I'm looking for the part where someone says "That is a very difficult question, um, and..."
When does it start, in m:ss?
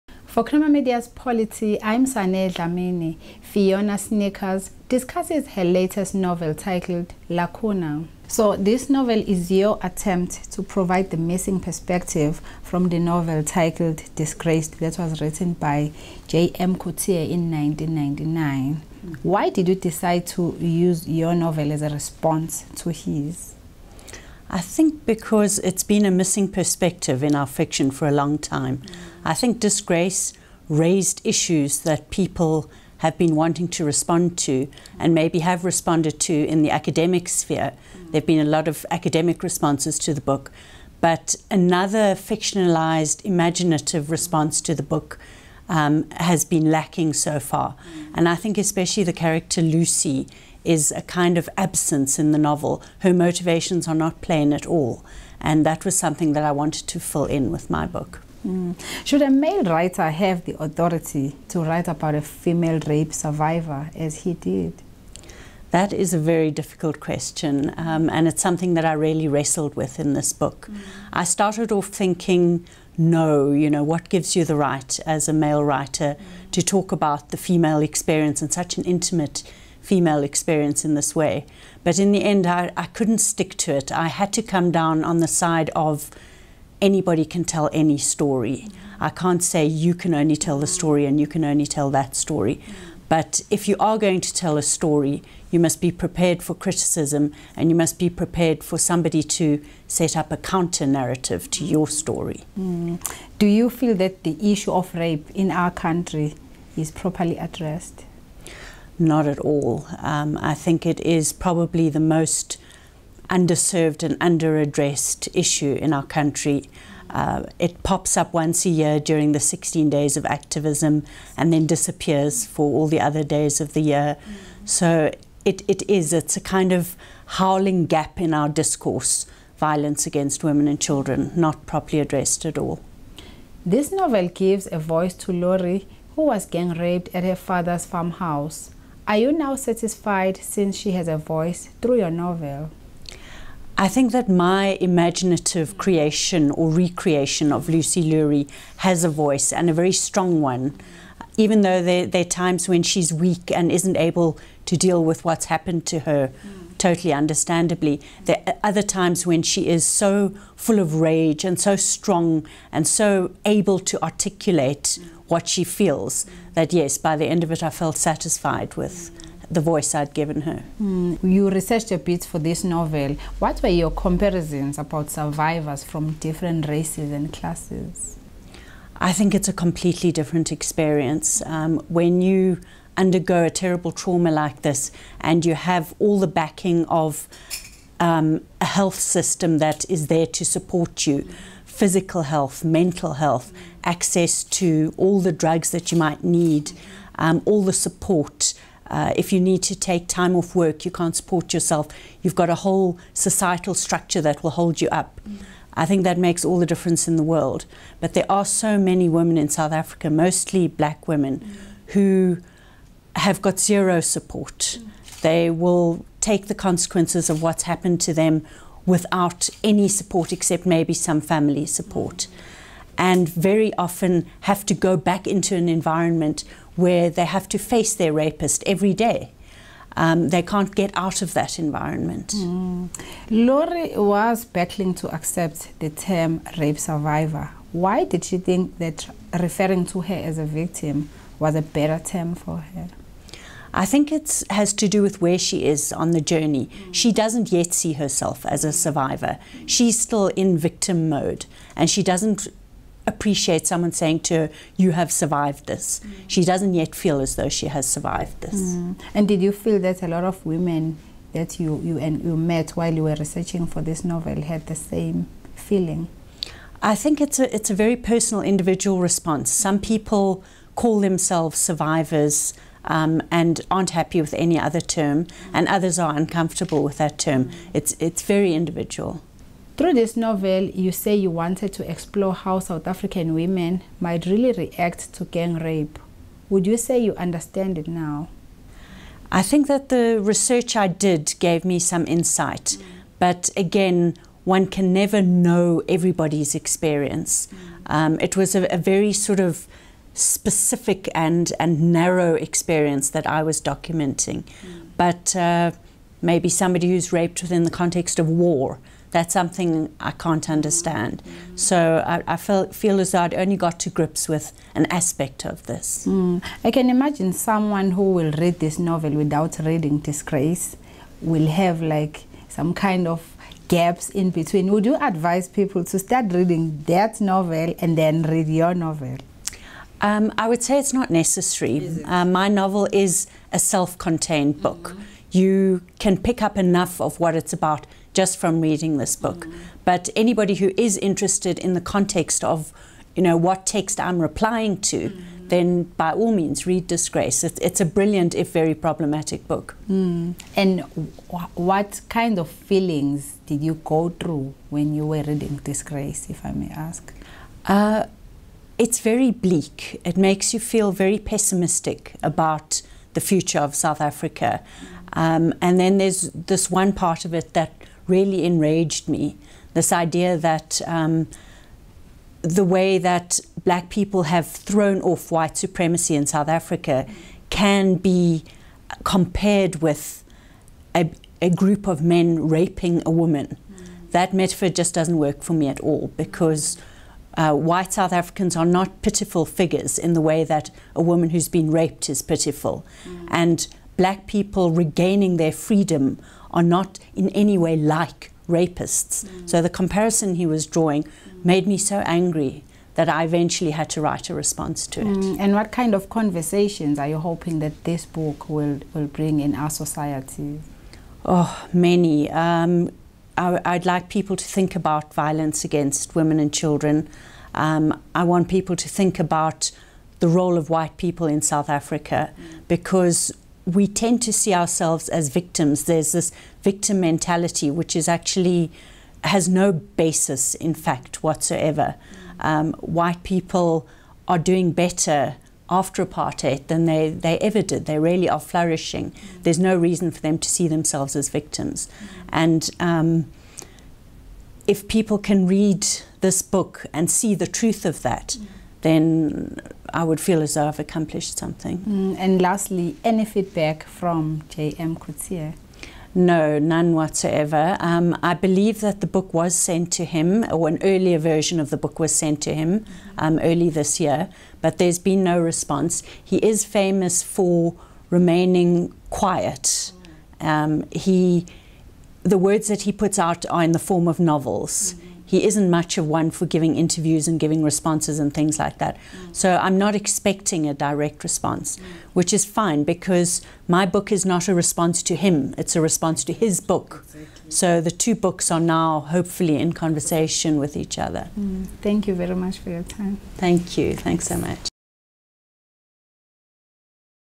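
1:05.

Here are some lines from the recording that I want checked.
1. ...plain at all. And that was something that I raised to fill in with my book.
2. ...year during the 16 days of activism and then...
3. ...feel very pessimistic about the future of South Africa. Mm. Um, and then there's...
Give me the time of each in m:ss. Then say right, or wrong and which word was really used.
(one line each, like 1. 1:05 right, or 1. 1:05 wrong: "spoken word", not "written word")
1. 0:54 wrong: "wanted", not "raised"
2. 1:58 right
3. 6:00 right.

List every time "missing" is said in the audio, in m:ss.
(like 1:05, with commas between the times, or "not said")
0:11, 0:26.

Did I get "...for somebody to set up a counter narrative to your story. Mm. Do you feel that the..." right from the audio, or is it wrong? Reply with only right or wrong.
right.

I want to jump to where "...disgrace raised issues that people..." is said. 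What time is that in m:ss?
0:29.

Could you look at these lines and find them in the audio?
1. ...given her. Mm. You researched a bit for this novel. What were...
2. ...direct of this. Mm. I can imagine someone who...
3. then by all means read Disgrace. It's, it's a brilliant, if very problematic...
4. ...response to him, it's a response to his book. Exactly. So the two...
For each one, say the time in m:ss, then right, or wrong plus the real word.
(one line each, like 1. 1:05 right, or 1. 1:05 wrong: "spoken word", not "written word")
1. 2:50 right
2. 5:14 wrong: "aspect", not "direct"
3. 5:45 right
4. 8:04 right.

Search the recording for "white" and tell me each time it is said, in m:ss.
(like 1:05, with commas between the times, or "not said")
6:15, 6:27, 7:00, 7:12.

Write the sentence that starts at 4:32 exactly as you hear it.
Um, and aren't happy with any other term, and others are uncomfortable with that term.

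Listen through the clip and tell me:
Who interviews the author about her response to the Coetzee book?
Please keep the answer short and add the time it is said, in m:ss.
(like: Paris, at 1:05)
Saneh Dlamini, at 0:02.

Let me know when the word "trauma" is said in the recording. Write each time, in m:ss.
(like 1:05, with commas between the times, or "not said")
3:03.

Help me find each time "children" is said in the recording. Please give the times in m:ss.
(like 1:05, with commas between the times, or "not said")
2:10, 6:56.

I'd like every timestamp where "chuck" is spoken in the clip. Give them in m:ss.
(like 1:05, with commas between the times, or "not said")
not said.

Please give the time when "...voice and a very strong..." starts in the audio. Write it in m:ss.
2:29.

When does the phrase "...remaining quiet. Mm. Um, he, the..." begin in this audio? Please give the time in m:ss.
7:48.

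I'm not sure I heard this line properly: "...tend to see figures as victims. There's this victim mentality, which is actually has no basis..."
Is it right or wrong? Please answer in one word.
wrong.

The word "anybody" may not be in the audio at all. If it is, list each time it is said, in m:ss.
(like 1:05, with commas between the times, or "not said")
1:26, 5:40.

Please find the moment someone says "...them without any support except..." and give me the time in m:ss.
3:38.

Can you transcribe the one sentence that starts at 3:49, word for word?
Um, they can't get out of that environment.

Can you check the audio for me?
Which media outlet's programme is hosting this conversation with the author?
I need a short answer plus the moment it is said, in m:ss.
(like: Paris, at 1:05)
Creamer Media's Polity, at 0:00.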